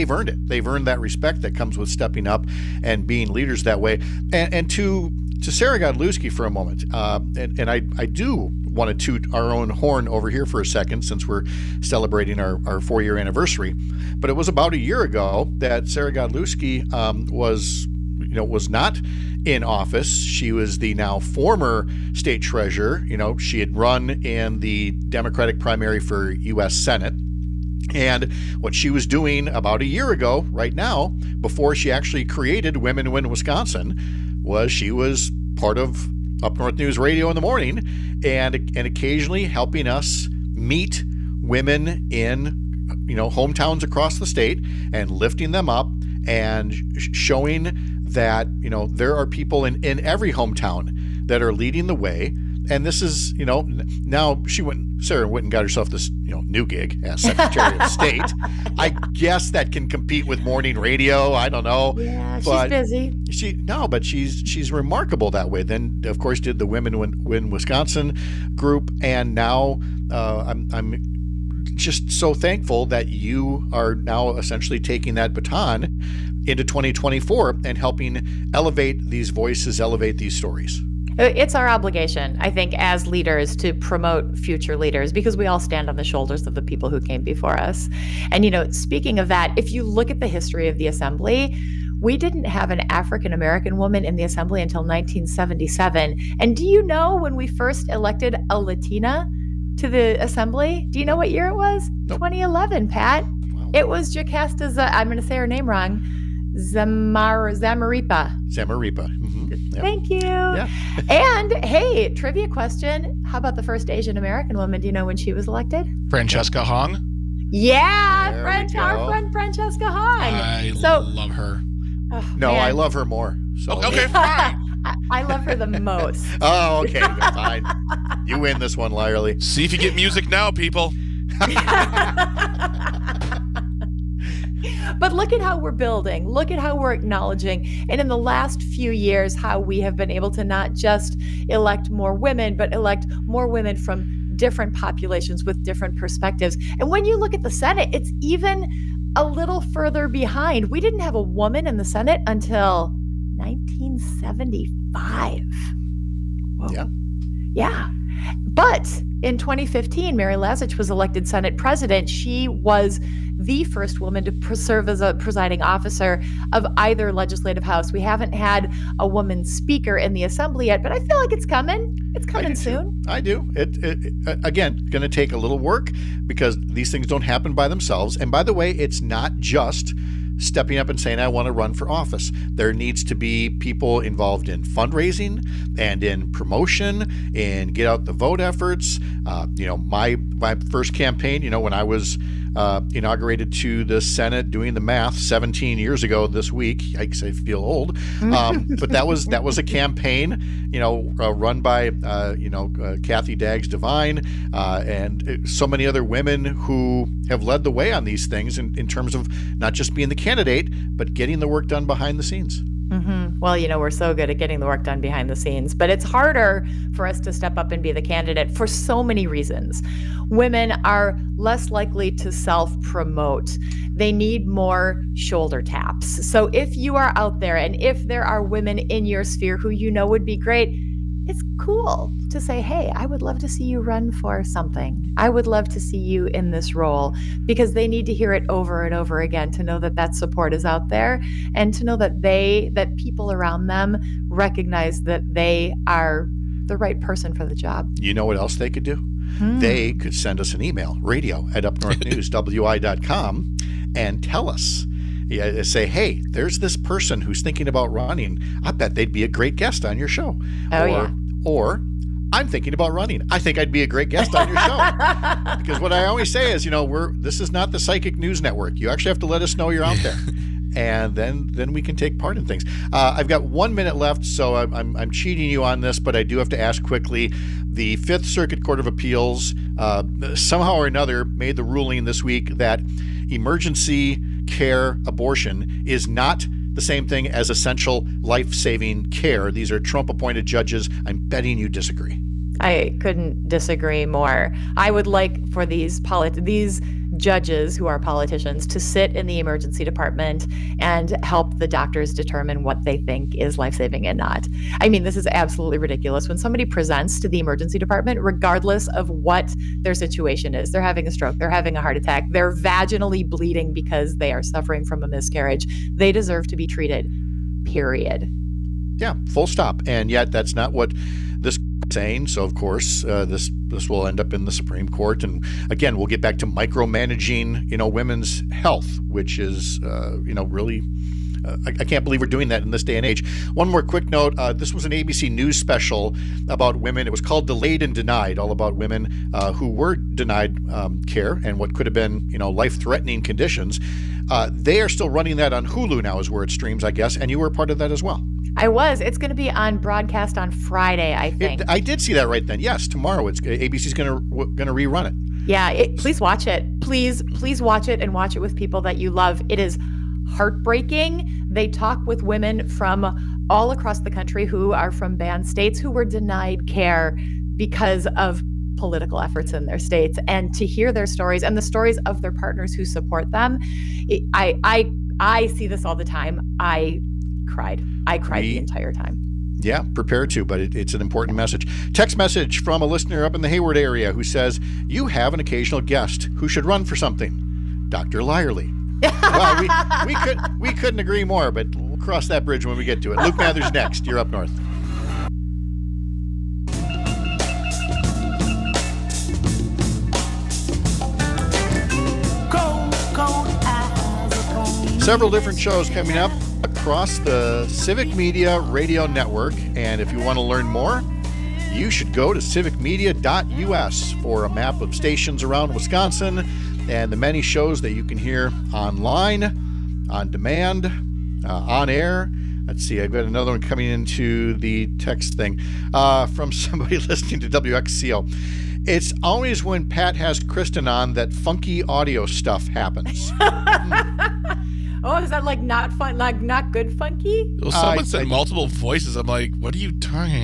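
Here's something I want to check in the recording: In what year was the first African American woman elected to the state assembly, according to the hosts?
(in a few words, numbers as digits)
1977.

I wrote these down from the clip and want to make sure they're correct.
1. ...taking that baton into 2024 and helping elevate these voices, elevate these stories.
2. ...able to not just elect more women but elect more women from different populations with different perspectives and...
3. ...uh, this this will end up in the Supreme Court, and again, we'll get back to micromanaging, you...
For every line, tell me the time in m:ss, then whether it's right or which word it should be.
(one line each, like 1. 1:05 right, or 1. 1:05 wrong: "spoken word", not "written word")
1. 1:14 right
2. 2:20 right
3. 5:23 right.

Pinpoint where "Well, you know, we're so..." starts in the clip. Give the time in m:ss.
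3:33.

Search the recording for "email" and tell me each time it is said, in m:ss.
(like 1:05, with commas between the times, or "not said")
4:10.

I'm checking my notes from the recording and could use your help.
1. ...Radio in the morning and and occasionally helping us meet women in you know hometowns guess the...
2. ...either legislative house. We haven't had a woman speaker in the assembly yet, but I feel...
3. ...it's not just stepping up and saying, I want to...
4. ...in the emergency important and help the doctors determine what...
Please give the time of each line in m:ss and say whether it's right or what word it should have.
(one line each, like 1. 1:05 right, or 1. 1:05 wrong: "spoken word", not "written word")
1. 0:36 wrong: "across", not "guess"
2. 2:46 right
3. 2:58 right
4. 4:59 wrong: "department", not "important".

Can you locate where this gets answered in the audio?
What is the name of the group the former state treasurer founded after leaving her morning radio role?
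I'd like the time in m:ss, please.
0:32.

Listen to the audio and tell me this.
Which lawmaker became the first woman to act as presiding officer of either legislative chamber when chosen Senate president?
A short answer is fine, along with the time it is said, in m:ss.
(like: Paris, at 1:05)
Mary Lazich, at 2:40.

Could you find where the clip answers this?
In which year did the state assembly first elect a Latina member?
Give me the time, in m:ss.
1:42.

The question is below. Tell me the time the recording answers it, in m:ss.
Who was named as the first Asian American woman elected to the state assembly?
1:59.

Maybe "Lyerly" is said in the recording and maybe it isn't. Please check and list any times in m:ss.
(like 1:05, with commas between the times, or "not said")
2:08, 6:28.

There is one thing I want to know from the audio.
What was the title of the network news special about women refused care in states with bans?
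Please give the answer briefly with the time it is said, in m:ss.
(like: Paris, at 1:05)
Delayed and Denied, at 5:37.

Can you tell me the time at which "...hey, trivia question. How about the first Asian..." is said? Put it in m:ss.
1:51.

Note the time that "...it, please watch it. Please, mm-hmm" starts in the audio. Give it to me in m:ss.
5:55.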